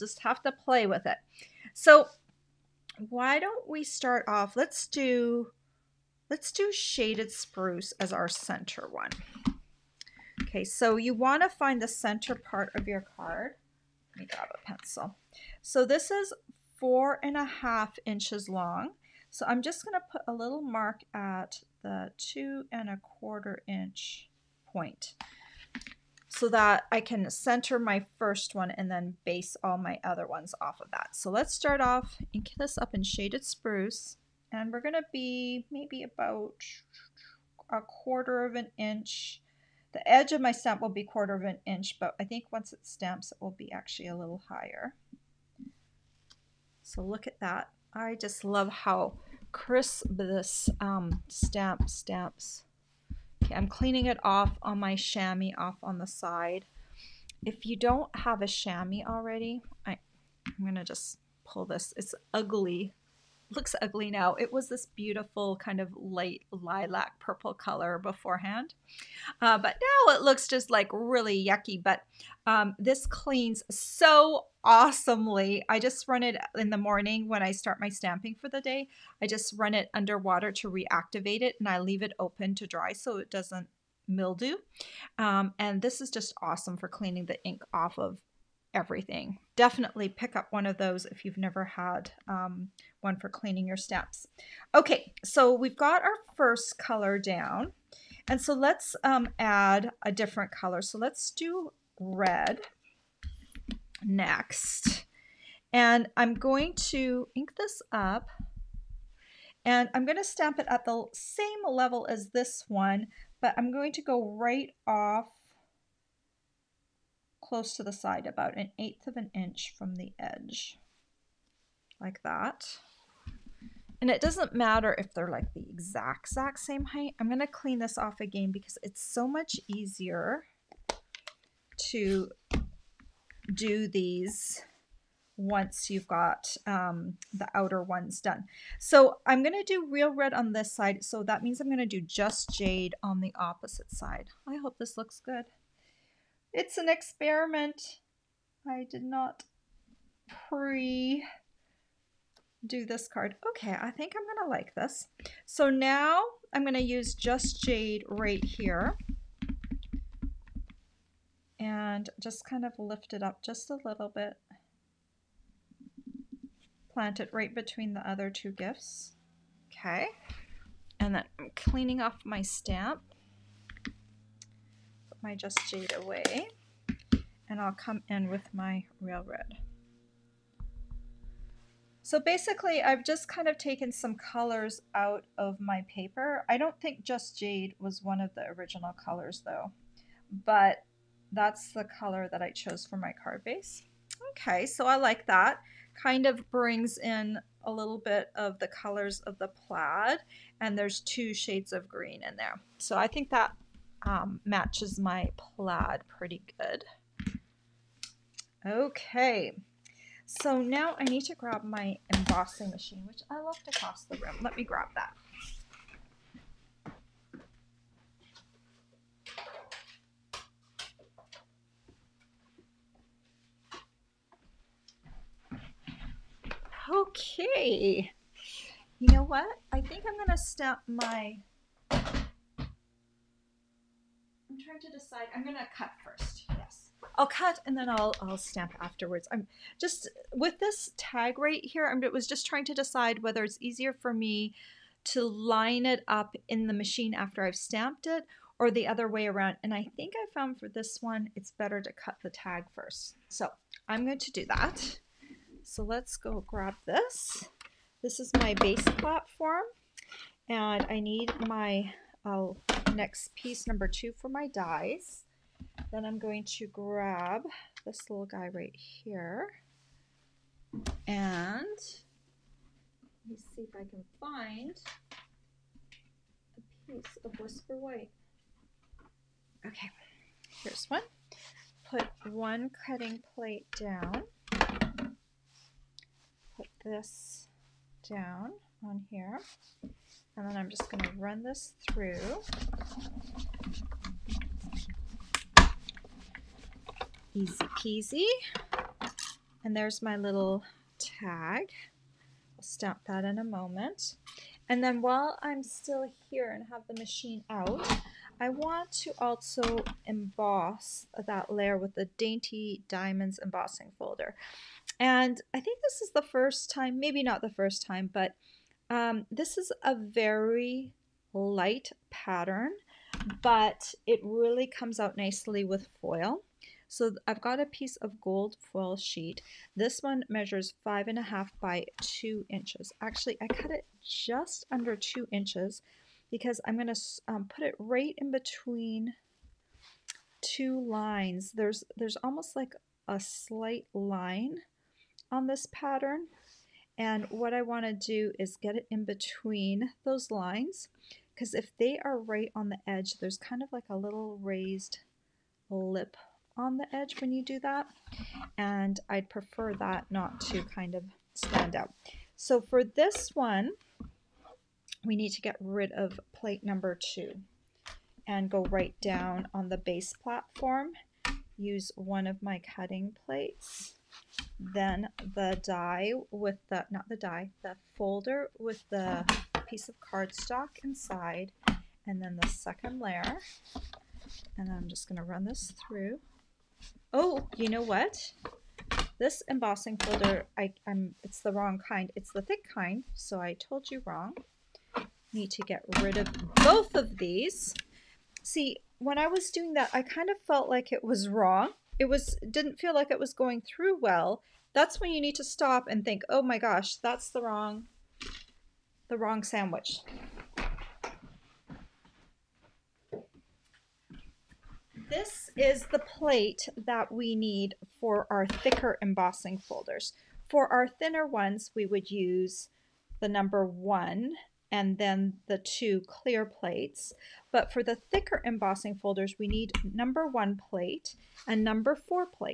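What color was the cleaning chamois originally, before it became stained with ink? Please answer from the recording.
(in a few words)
Light lilac purple.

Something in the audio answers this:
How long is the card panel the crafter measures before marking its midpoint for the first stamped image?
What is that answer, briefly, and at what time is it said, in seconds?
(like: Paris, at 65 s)
4 1/2 inches, at 16 s.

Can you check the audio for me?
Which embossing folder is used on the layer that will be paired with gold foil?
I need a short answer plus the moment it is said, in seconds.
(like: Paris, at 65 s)
Dainty Diamonds, at 312 s.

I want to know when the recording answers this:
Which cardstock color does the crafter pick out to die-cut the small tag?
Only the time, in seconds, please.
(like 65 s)
277 s.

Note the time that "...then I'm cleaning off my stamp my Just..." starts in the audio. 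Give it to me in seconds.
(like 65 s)
171 s.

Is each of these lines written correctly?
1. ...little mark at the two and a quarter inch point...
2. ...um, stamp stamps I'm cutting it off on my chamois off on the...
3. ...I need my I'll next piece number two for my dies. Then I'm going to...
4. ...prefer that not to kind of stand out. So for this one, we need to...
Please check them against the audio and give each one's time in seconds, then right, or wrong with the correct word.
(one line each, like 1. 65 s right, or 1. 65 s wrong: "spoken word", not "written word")
1. 20 s right
2. 50 s wrong: "cleaning", not "cutting"
3. 260 s right
4. 359 s right.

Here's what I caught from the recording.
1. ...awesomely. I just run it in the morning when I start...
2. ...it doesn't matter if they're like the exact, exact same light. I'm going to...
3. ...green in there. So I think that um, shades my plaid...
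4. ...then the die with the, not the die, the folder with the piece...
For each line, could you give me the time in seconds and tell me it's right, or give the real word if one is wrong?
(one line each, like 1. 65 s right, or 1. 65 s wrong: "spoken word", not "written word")
1. 74 s right
2. 124 s wrong: "height", not "light"
3. 201 s wrong: "matches", not "shades"
4. 374 s right.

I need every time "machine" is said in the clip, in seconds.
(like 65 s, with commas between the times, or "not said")
212 s, 246 s, 306 s.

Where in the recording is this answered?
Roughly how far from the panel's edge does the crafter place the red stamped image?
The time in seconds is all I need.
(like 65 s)
118 s.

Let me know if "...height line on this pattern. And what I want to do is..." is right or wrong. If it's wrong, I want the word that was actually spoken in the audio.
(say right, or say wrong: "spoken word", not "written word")
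wrong: "slight", not "height".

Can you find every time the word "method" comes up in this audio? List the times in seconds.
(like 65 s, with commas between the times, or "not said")
not said.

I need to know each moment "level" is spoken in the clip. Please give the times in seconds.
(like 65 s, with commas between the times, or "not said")
111 s.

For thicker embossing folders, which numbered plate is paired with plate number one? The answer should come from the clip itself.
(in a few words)
4.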